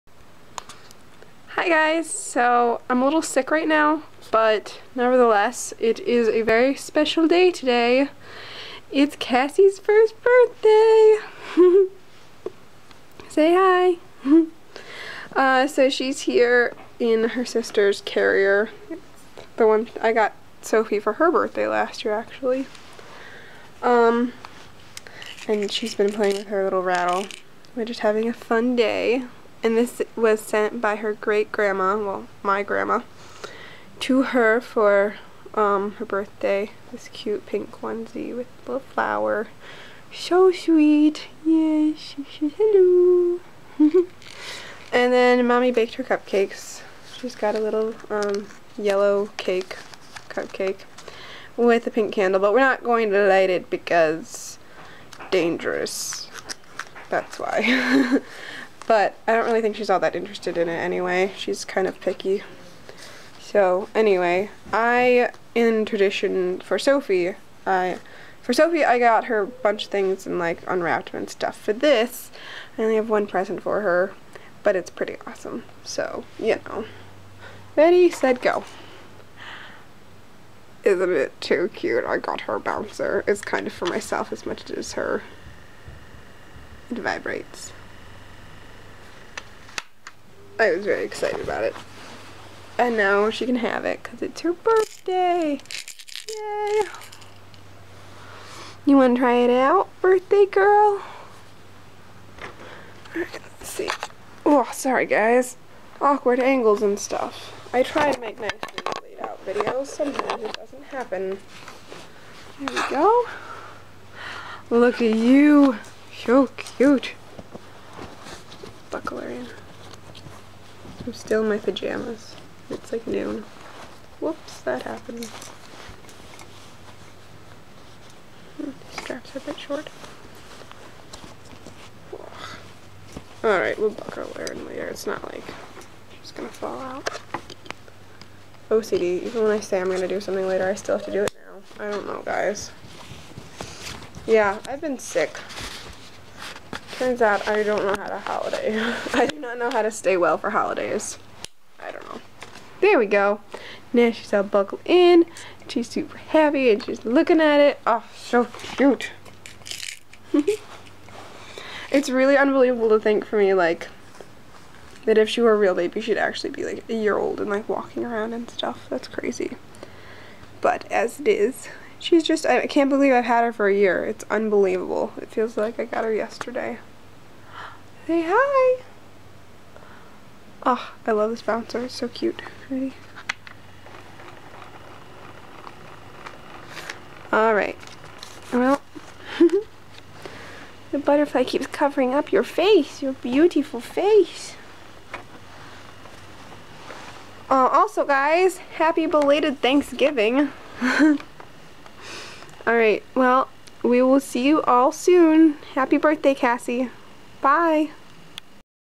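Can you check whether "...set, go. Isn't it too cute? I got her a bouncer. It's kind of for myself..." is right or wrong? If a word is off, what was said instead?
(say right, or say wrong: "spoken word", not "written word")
right.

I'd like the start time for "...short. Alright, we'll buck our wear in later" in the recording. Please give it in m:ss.
2:09.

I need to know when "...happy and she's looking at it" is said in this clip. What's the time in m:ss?
2:36.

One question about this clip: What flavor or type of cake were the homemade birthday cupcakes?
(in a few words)
Yellow cake.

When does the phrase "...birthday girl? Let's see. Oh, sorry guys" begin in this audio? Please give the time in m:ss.
1:40.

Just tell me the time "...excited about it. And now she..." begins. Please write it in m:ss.
1:31.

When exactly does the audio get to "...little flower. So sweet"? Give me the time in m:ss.
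0:38.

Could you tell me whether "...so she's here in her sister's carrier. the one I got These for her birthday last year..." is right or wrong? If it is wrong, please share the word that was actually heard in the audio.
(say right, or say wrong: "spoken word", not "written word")
wrong: "Sophie", not "These".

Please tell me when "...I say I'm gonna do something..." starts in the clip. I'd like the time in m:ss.
2:19.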